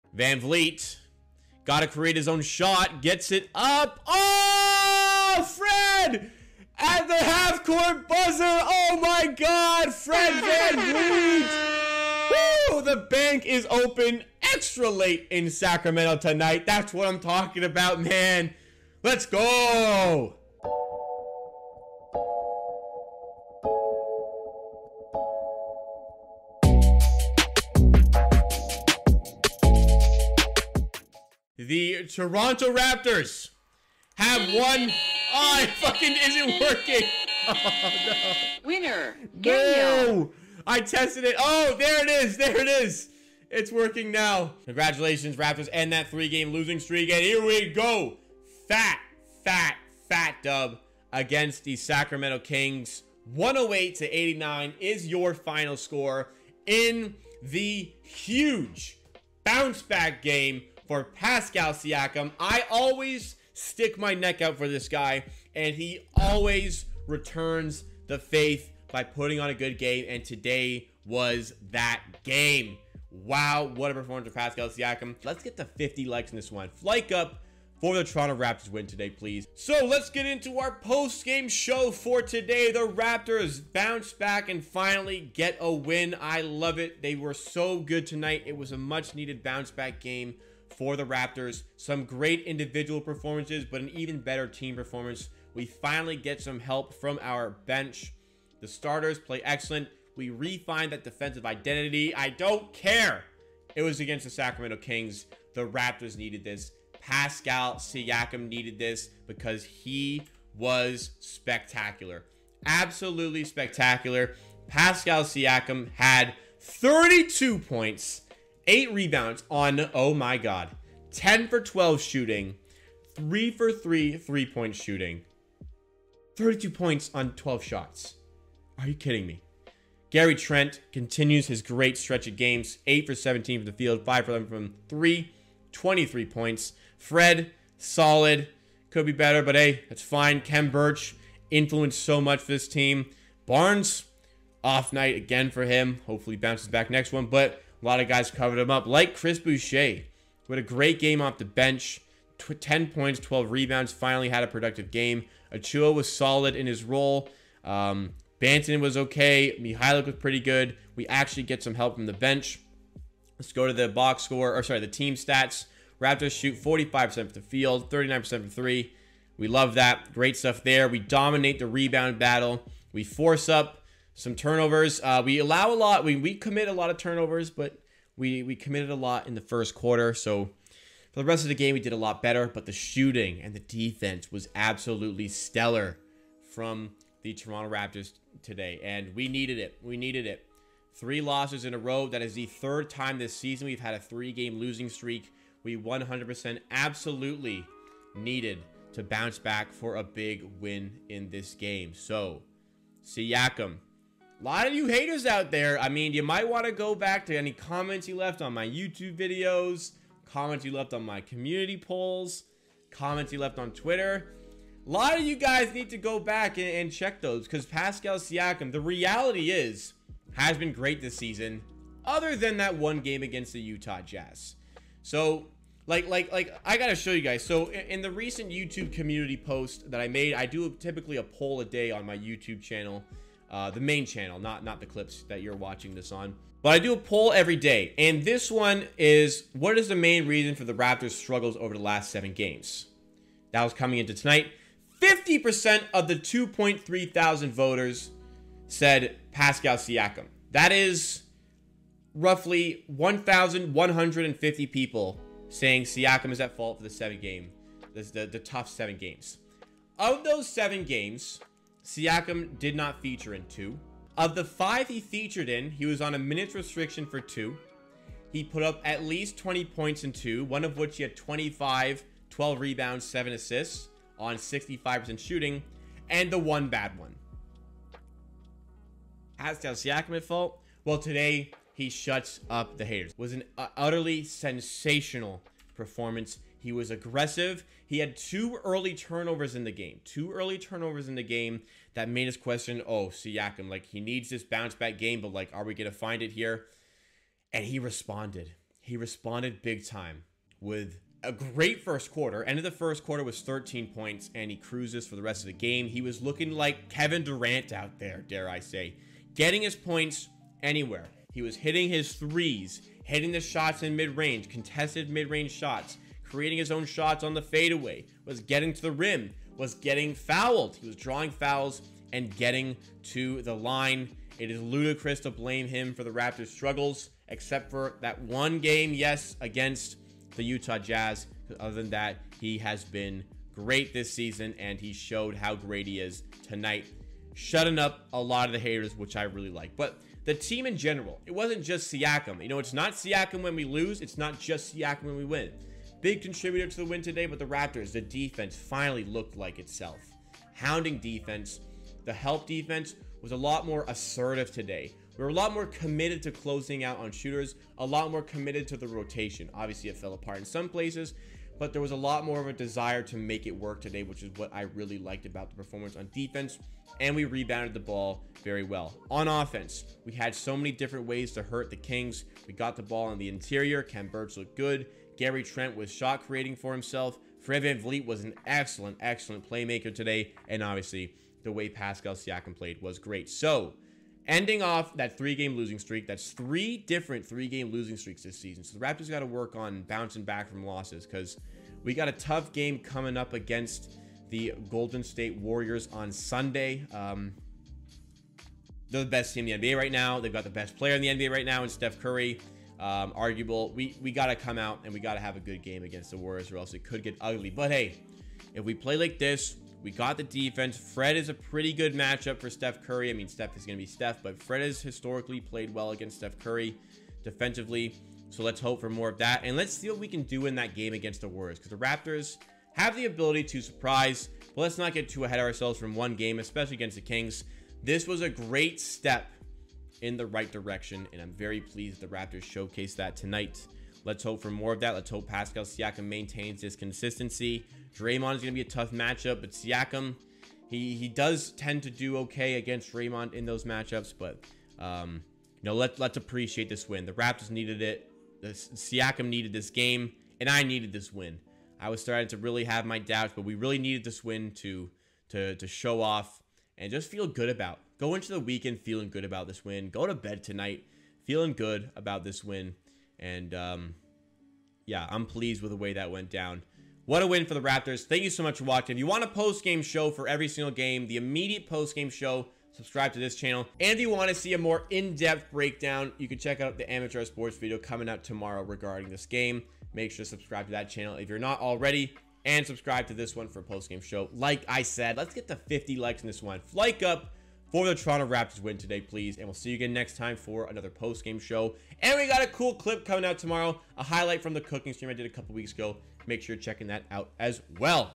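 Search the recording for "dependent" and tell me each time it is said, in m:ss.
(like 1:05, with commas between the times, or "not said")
not said.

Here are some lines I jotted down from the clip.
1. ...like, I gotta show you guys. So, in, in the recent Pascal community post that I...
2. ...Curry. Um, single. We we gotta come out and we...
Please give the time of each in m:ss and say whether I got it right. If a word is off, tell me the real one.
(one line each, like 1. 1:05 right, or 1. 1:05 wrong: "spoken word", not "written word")
1. 3:46 wrong: "YouTube", not "Pascal"
2. 6:41 wrong: "arguable", not "single".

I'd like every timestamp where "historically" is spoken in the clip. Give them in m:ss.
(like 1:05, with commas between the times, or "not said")
6:54.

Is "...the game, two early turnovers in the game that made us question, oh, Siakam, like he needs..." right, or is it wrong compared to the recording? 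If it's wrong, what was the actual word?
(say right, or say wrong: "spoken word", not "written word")
right.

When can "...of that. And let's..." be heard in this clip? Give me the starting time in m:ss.
6:59.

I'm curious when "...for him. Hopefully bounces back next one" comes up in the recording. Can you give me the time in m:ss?
2:25.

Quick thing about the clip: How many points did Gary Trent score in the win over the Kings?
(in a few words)
23.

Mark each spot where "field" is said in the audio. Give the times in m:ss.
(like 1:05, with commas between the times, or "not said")
2:13, 2:47.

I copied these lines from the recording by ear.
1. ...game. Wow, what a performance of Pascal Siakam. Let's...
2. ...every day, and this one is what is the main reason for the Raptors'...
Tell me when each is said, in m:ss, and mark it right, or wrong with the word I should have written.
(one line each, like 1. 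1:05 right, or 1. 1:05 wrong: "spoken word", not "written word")
1. 1:12 right
2. 3:57 right.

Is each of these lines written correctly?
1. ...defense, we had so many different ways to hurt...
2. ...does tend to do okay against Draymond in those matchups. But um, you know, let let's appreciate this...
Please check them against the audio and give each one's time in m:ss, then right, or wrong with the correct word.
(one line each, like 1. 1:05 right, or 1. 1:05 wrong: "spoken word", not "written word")
1. 6:09 wrong: "offense", not "defense"
2. 7:21 right.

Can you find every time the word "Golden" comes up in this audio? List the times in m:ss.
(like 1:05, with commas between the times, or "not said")
6:34.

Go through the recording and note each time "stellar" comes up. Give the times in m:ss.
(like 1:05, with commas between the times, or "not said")
3:05.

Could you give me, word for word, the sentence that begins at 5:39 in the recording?
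But the team in general, it wasn't just Siakam.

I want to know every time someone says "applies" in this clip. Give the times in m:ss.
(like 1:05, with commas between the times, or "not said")
not said.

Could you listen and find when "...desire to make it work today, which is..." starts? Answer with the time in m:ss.
6:02.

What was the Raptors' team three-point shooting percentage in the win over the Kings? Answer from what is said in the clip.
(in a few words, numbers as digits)
39%.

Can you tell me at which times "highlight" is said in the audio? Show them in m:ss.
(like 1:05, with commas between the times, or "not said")
8:14.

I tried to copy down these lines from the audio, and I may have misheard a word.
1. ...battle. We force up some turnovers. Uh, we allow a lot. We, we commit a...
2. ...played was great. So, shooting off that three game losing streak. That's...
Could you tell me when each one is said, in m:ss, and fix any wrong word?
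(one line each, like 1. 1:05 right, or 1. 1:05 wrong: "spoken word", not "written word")
1. 2:52 right
2. 6:22 wrong: "ending", not "shooting".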